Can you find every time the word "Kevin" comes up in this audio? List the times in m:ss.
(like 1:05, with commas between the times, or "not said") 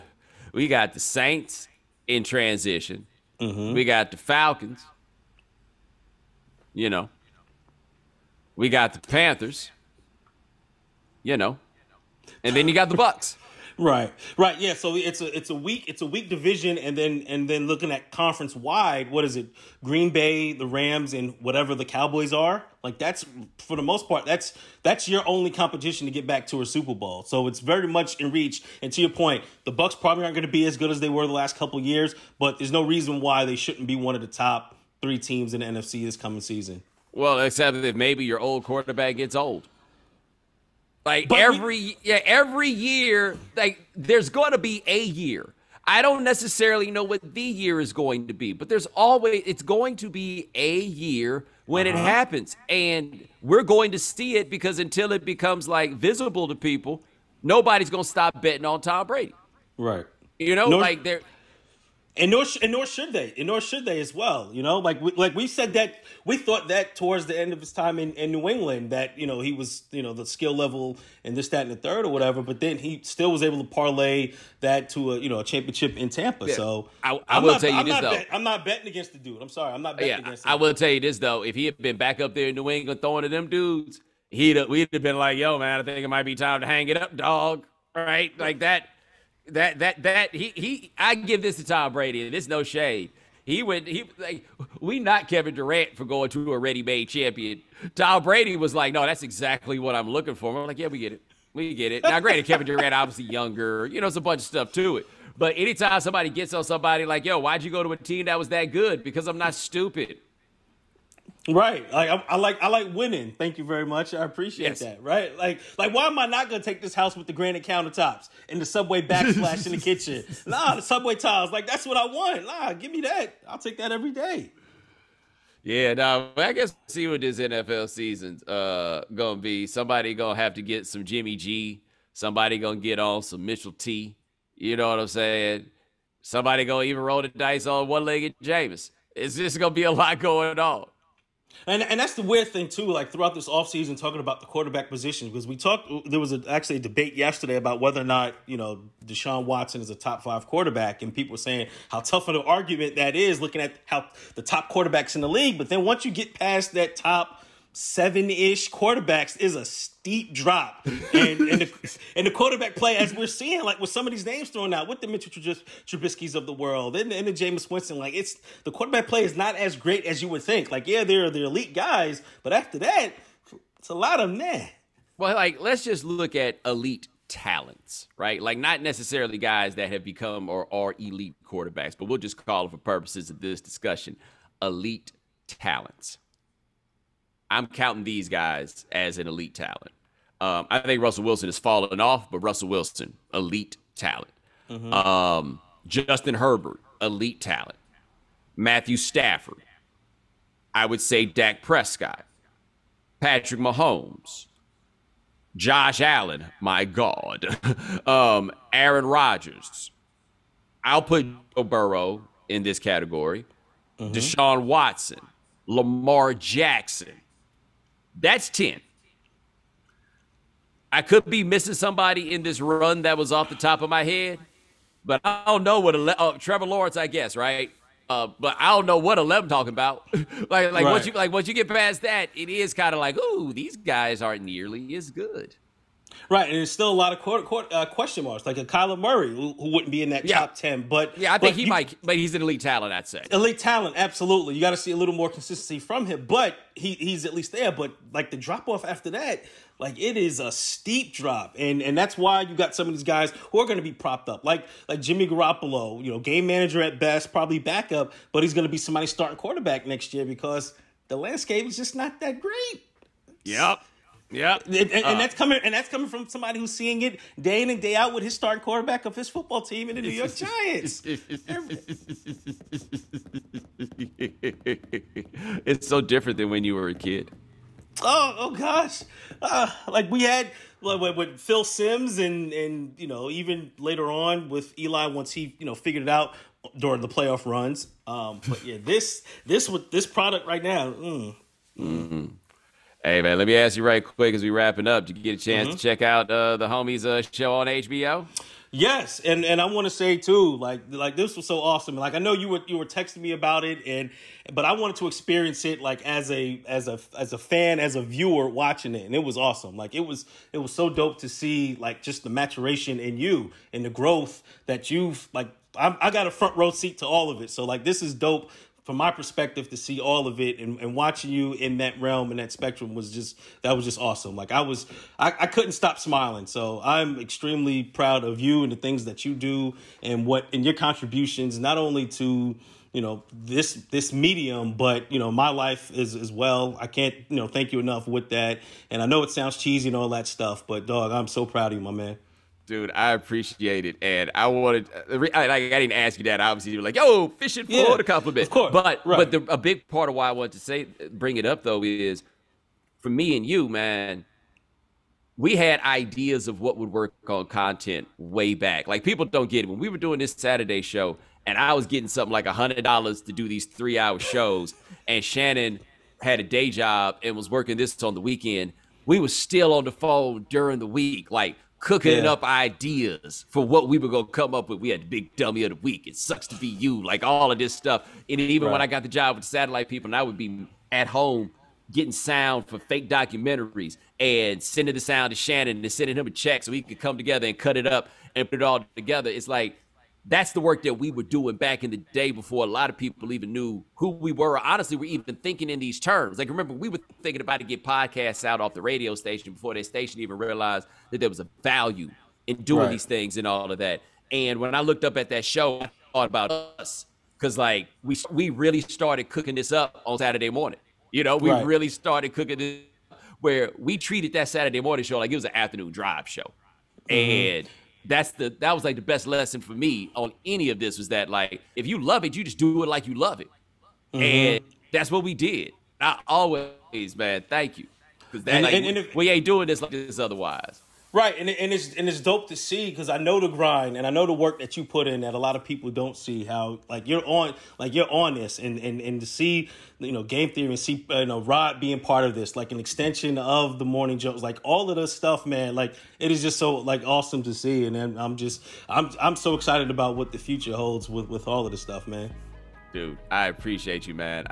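1:35, 1:42.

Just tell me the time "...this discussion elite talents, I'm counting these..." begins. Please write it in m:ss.
3:03.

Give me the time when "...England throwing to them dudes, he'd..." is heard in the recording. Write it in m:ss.
1:22.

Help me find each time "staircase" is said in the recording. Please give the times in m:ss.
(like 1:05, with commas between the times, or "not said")
not said.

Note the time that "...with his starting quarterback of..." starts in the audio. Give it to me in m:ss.
4:28.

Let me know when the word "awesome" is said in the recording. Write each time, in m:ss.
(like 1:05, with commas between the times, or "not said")
5:01, 5:09, 5:23, 7:27.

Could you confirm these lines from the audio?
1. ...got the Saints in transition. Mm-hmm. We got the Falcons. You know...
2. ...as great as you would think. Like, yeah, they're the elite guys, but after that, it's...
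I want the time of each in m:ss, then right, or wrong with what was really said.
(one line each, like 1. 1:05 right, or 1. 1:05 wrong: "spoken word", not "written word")
1. 0:00 right
2. 2:49 right.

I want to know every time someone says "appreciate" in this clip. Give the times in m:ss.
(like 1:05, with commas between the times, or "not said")
1:54, 5:43, 7:33.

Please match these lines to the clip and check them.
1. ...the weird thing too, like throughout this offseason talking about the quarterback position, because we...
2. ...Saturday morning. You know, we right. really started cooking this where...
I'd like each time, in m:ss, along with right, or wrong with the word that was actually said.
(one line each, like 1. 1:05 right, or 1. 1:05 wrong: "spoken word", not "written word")
1. 2:22 right
2. 6:50 right.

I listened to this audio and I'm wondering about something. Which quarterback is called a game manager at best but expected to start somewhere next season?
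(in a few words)
Jimmy Garoppolo.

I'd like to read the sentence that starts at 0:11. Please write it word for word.
You know, and then you got the Bucs.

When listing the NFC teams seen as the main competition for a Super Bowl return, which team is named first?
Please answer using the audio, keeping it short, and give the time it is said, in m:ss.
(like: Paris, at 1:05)
Green Bay, at 0:19.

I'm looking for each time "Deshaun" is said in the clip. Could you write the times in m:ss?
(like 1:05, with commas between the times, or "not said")
2:29, 3:34.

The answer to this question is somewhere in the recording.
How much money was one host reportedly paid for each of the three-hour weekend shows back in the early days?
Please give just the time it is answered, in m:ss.
6:02.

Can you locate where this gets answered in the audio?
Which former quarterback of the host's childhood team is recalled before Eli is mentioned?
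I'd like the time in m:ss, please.
4:41.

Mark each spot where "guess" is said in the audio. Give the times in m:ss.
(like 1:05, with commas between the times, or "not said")
2:06, 3:47.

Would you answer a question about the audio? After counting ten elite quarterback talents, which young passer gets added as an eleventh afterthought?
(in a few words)
Trevor Lawrence.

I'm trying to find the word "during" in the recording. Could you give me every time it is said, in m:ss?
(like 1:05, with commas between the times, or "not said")
4:46, 6:10.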